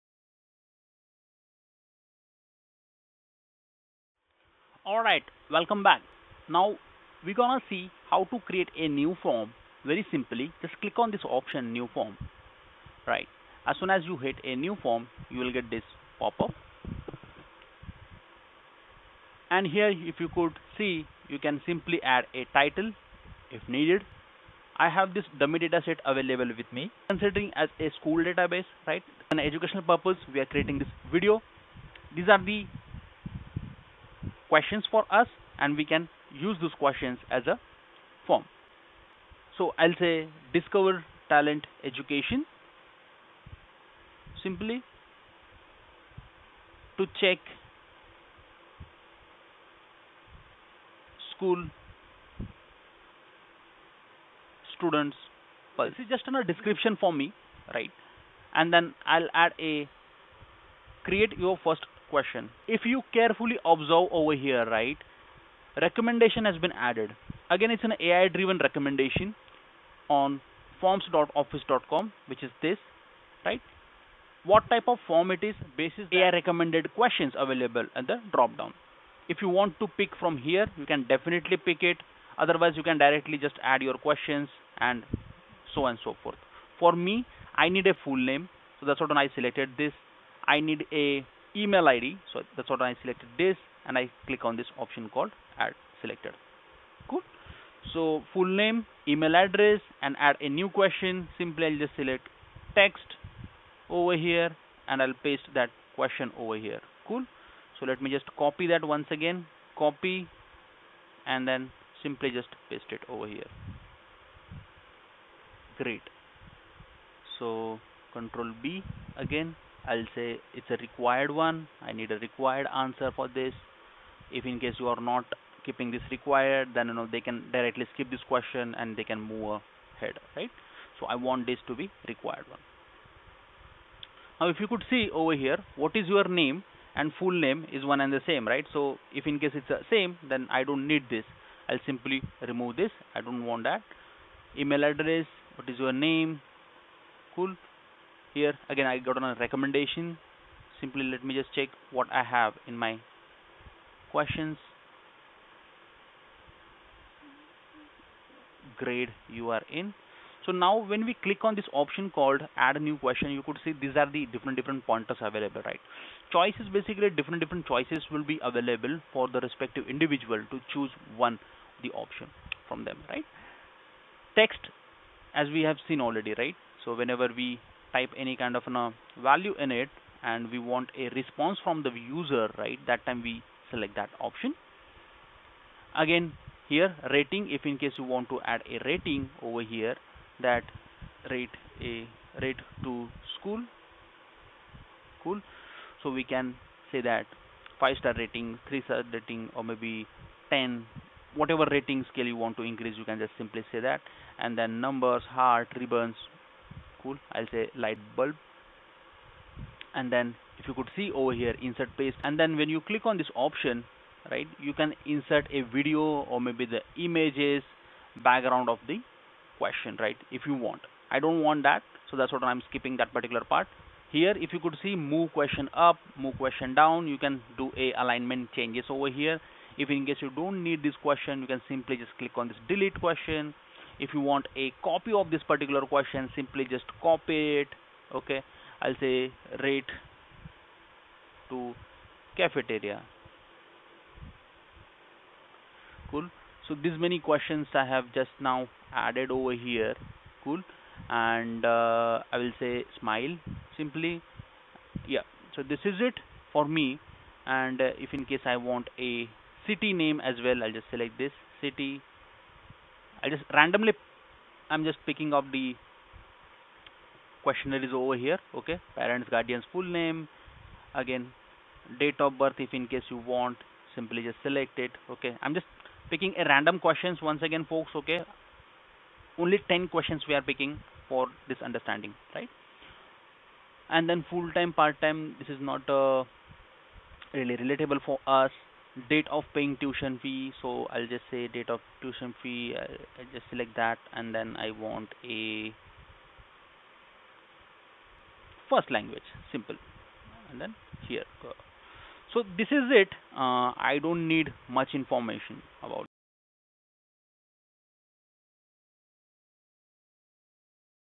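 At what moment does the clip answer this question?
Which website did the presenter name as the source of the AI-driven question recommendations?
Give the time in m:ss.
1:10.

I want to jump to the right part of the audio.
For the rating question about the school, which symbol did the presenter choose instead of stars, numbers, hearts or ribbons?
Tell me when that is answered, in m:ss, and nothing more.
3:27.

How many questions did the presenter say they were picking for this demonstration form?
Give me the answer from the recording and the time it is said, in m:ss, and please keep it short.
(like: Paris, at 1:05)
10, at 4:39.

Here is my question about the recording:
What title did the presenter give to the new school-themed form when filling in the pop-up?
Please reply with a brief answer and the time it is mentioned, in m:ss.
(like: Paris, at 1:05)
Discover Talent, at 0:40.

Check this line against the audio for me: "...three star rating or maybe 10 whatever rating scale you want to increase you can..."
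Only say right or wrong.
right.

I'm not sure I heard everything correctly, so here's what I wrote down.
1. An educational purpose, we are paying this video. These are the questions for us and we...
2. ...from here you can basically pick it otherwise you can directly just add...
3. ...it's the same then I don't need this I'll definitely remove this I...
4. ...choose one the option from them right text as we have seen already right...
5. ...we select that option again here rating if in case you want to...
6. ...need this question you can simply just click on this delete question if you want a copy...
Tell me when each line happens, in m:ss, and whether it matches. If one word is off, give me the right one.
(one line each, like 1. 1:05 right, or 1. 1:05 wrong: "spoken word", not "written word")
1. 0:29 wrong: "creating", not "paying"
2. 1:20 wrong: "definitely", not "basically"
3. 2:19 wrong: "simply", not "definitely"
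4. 2:50 right
5. 3:03 right
6. 3:50 right.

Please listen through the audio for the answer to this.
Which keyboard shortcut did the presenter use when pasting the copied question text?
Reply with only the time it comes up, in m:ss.
1:58.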